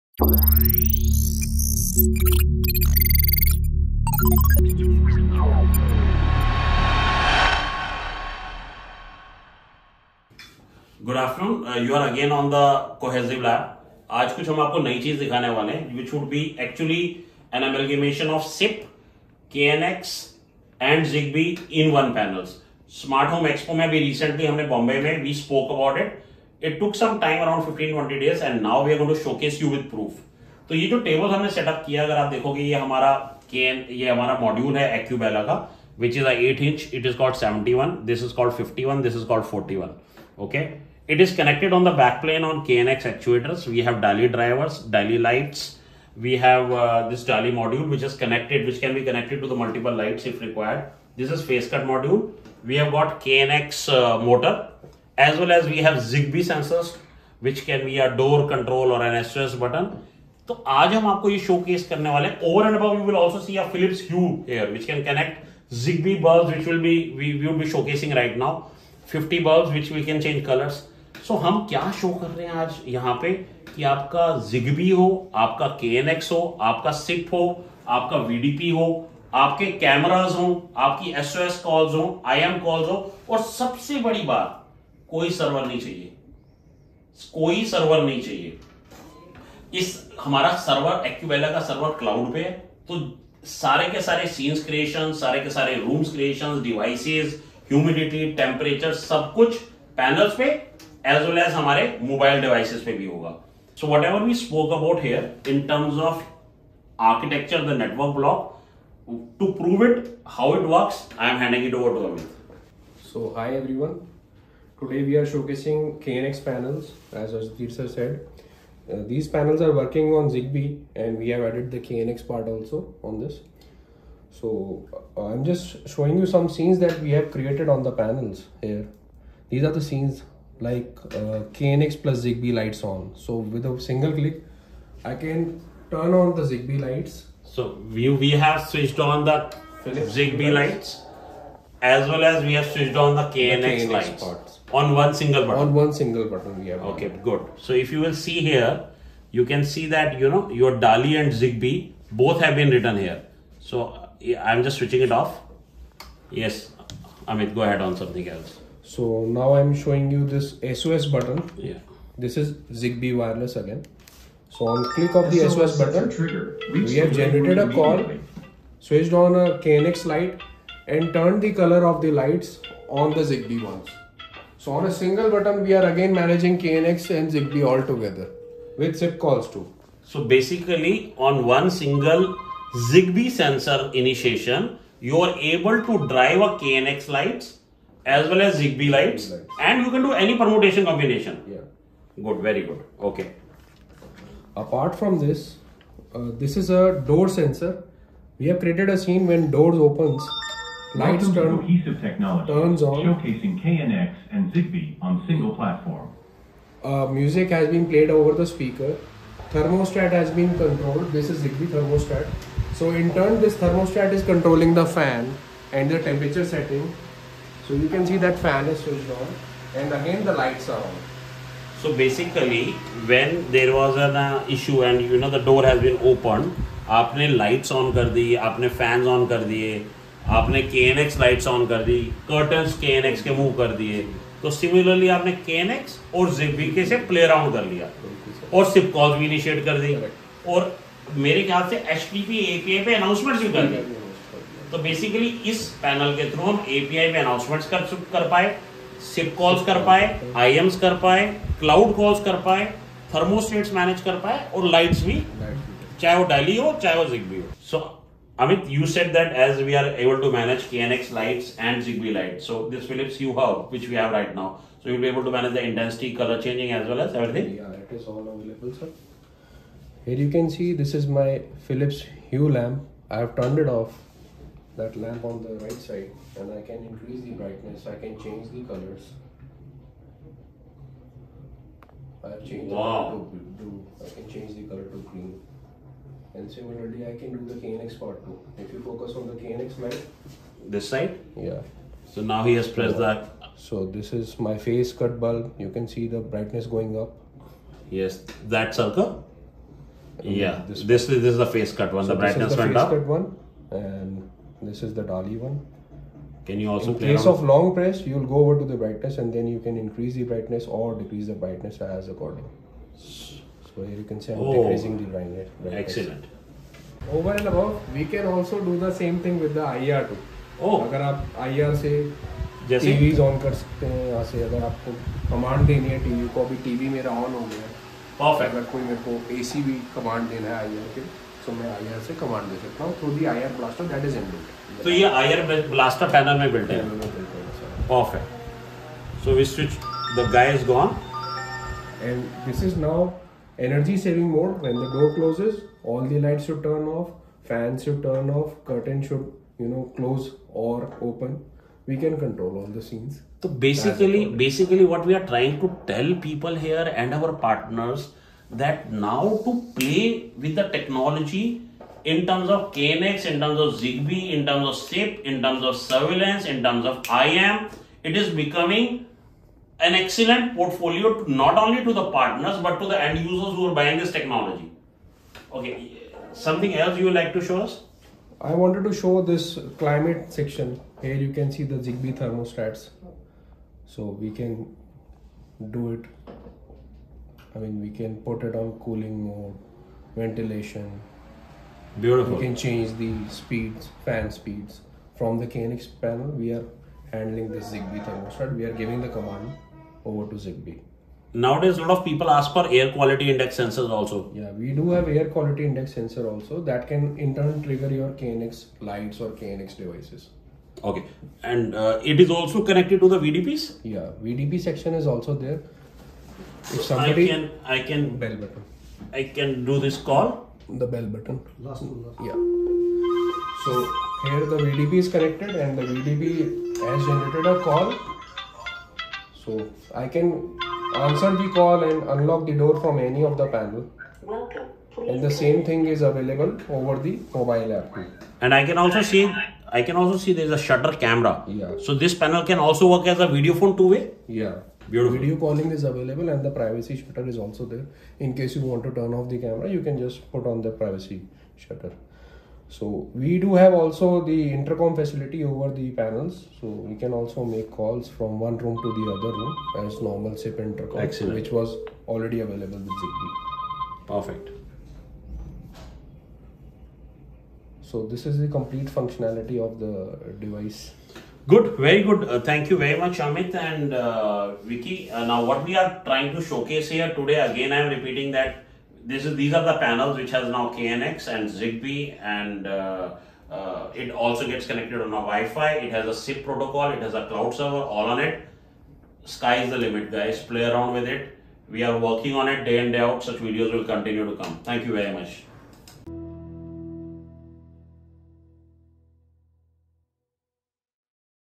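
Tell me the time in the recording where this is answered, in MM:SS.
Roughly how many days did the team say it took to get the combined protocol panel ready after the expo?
00:27.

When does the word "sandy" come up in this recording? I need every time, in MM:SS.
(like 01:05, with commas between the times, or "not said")
not said.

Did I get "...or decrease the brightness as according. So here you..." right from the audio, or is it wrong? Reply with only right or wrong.
right.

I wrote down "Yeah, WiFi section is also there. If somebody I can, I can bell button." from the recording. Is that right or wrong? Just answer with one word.
wrong.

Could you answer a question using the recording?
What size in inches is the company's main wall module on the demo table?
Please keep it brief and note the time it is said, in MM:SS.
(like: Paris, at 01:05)
8 inch, at 00:36.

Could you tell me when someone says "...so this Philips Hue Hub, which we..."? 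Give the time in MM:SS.
04:22.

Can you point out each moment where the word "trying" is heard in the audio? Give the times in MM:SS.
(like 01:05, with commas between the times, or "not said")
05:55, 07:56.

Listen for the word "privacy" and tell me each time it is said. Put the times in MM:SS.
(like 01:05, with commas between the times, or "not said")
07:26, 07:30.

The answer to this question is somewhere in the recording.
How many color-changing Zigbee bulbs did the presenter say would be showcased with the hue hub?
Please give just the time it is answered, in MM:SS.
01:09.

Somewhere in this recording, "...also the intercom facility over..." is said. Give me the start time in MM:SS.
07:33.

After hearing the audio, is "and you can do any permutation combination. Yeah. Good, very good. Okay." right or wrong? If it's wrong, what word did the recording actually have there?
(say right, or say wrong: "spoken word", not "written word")
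right.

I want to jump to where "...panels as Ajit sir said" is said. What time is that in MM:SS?
01:56.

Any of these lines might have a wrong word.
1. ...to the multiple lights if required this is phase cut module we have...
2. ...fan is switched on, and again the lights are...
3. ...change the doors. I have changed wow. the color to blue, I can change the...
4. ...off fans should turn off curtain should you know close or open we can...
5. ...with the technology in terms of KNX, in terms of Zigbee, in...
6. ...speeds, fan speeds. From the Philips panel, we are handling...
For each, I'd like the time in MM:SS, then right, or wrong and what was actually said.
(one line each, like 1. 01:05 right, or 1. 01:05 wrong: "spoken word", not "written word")
1. 00:49 right
2. 03:38 right
3. 04:38 wrong: "colors", not "doors"
4. 05:46 right
5. 06:00 right
6. 06:33 wrong: "KNX", not "Philips".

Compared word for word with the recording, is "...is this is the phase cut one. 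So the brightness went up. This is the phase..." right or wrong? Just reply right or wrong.
right.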